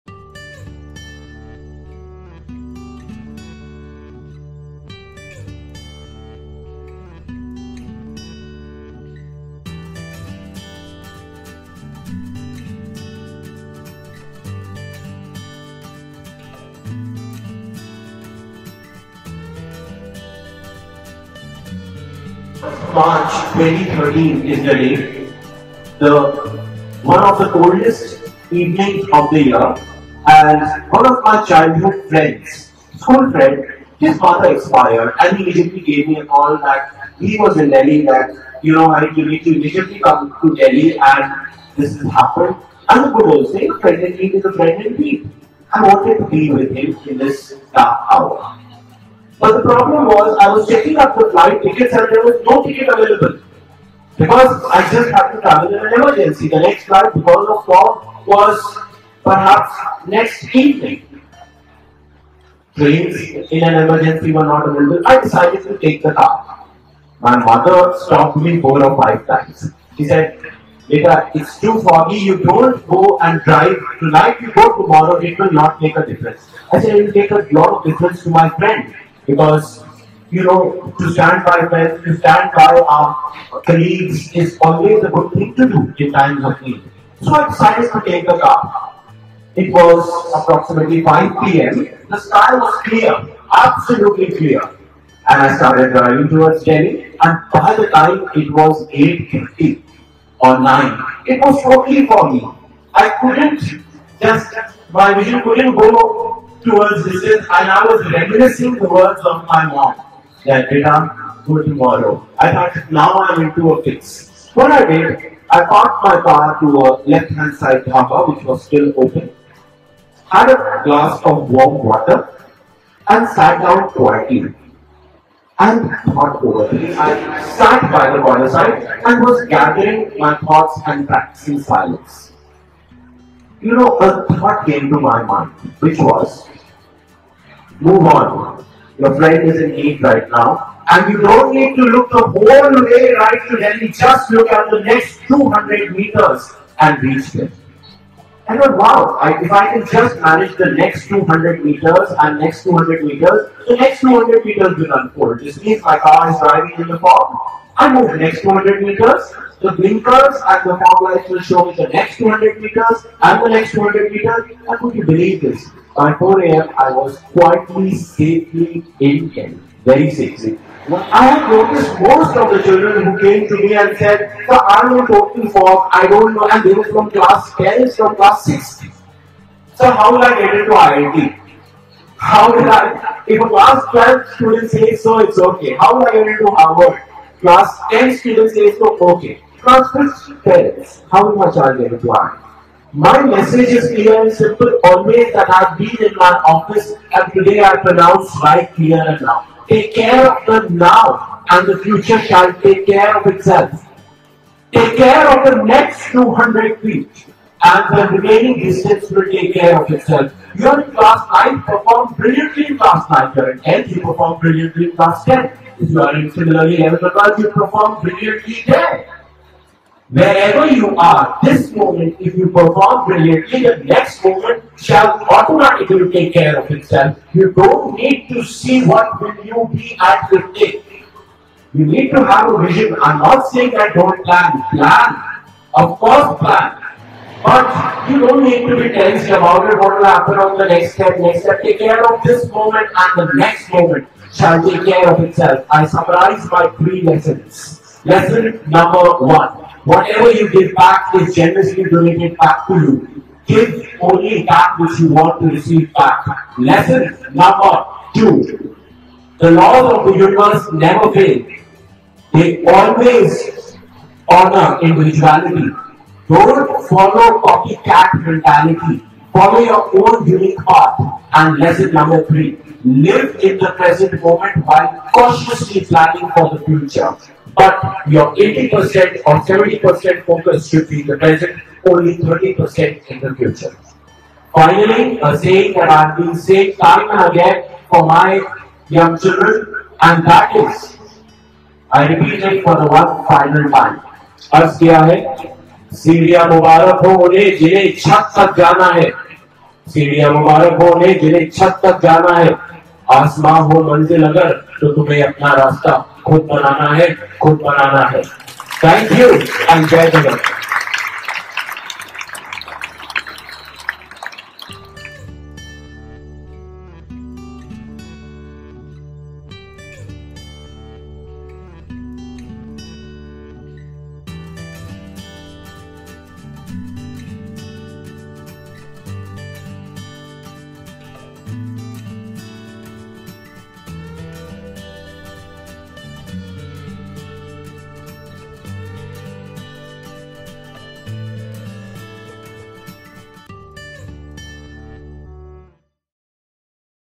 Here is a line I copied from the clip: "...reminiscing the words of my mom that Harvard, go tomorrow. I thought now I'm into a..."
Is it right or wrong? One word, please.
wrong.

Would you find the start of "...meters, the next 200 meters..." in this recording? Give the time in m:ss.
2:33.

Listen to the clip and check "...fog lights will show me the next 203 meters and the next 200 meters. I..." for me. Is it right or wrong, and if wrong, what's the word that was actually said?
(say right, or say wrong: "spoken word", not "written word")
wrong: "200", not "203".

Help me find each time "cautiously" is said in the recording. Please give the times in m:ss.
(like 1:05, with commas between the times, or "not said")
4:35.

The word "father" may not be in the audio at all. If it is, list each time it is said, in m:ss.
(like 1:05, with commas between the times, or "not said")
0:34.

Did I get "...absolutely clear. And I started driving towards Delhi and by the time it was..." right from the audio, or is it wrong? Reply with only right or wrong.
right.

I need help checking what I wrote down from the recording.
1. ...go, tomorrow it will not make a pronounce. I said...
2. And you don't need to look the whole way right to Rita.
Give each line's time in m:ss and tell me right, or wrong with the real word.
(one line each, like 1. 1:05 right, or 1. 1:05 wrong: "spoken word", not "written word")
1. 1:14 wrong: "difference", not "pronounce"
2. 2:20 wrong: "Delhi", not "Rita".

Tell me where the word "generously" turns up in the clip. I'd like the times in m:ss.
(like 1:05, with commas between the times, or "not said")
4:11.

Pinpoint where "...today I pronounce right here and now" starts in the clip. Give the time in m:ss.
3:17.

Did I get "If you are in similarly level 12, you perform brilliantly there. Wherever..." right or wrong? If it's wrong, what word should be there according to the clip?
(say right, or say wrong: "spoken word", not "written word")
right.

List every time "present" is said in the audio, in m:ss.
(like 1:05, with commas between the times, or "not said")
4:33, 4:41.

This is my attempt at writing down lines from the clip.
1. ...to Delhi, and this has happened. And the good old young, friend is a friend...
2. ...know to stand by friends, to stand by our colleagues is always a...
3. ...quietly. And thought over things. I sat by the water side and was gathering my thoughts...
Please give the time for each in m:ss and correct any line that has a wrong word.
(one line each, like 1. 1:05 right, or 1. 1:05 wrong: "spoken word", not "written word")
1. 0:40 wrong: "saying", not "young"
2. 1:20 right
3. 2:03 right.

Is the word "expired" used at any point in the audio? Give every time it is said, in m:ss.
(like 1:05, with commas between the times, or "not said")
0:34.